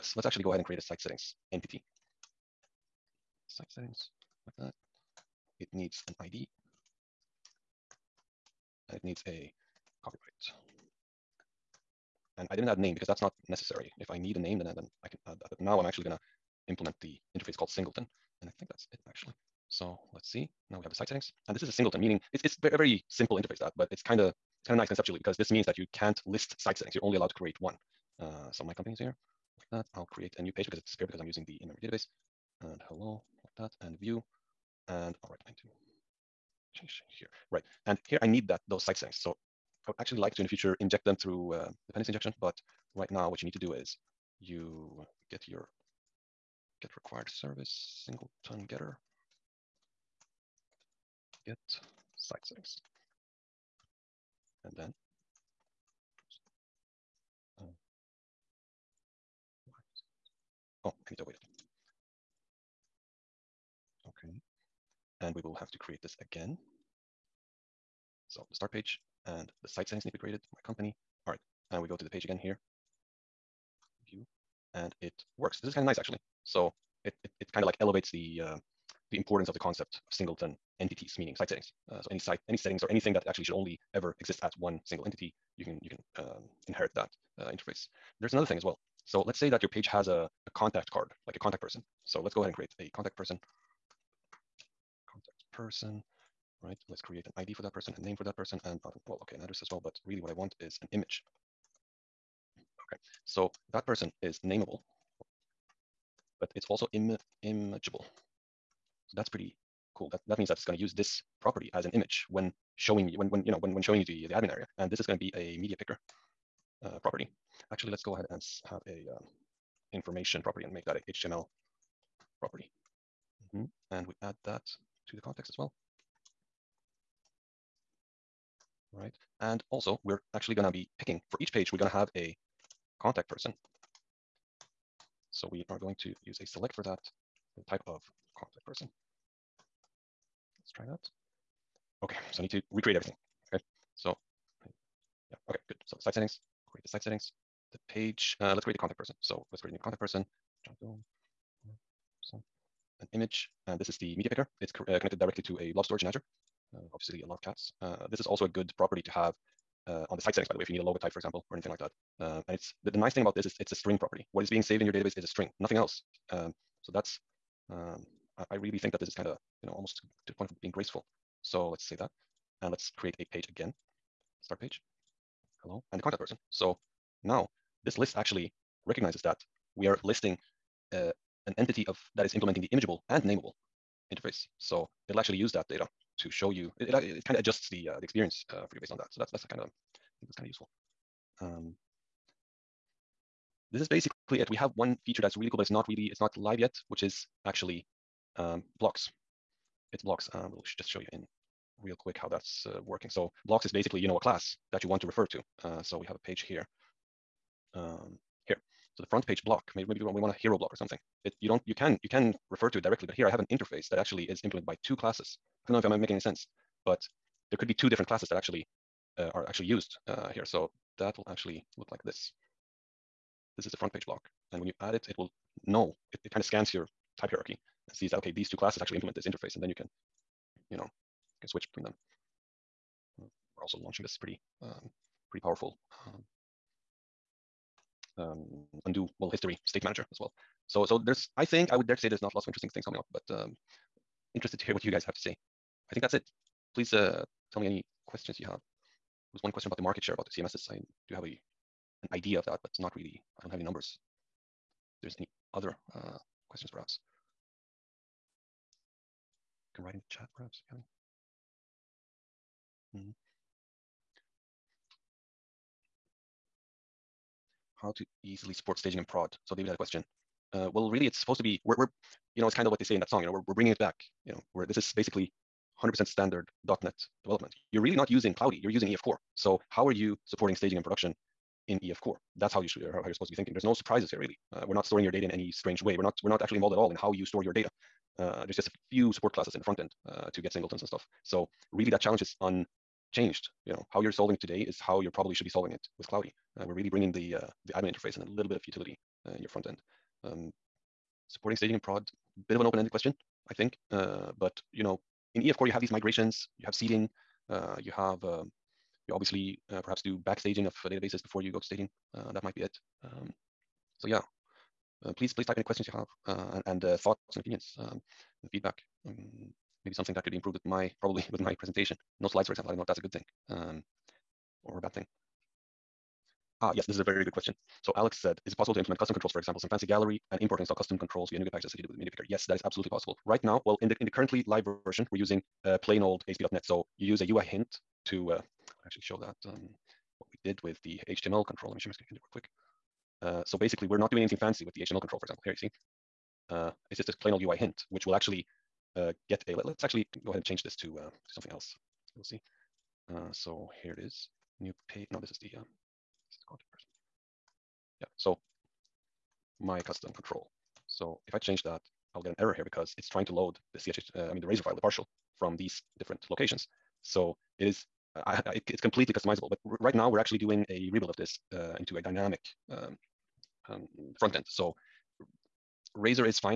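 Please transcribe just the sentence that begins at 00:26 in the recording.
You're only allowed to create one.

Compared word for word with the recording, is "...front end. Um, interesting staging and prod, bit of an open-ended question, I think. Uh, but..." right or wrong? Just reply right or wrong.
wrong.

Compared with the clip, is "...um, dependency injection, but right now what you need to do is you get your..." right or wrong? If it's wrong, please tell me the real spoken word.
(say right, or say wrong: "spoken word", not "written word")
right.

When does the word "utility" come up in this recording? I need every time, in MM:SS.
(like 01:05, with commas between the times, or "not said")
04:58.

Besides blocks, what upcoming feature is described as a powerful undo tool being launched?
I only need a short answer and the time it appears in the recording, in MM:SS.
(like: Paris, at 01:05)
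History state manager, at 03:59.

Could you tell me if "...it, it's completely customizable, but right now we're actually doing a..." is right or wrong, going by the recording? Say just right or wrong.
right.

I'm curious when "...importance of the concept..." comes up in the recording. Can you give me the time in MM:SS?
01:19.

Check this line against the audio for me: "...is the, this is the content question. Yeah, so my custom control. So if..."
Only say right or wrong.
wrong.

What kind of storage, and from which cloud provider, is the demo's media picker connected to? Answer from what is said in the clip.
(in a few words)
Blob storage in Azure.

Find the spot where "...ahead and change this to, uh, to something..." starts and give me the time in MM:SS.
05:50.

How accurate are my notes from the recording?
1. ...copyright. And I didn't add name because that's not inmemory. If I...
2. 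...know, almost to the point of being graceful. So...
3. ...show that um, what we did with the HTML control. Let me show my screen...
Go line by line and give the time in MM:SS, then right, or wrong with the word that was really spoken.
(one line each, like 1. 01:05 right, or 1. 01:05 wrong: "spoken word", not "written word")
1. 00:10 wrong: "necessary", not "inmemory"
2. 02:49 right
3. 05:39 right.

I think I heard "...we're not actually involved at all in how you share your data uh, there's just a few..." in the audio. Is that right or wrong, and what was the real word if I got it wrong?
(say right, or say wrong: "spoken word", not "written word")
wrong: "store", not "share".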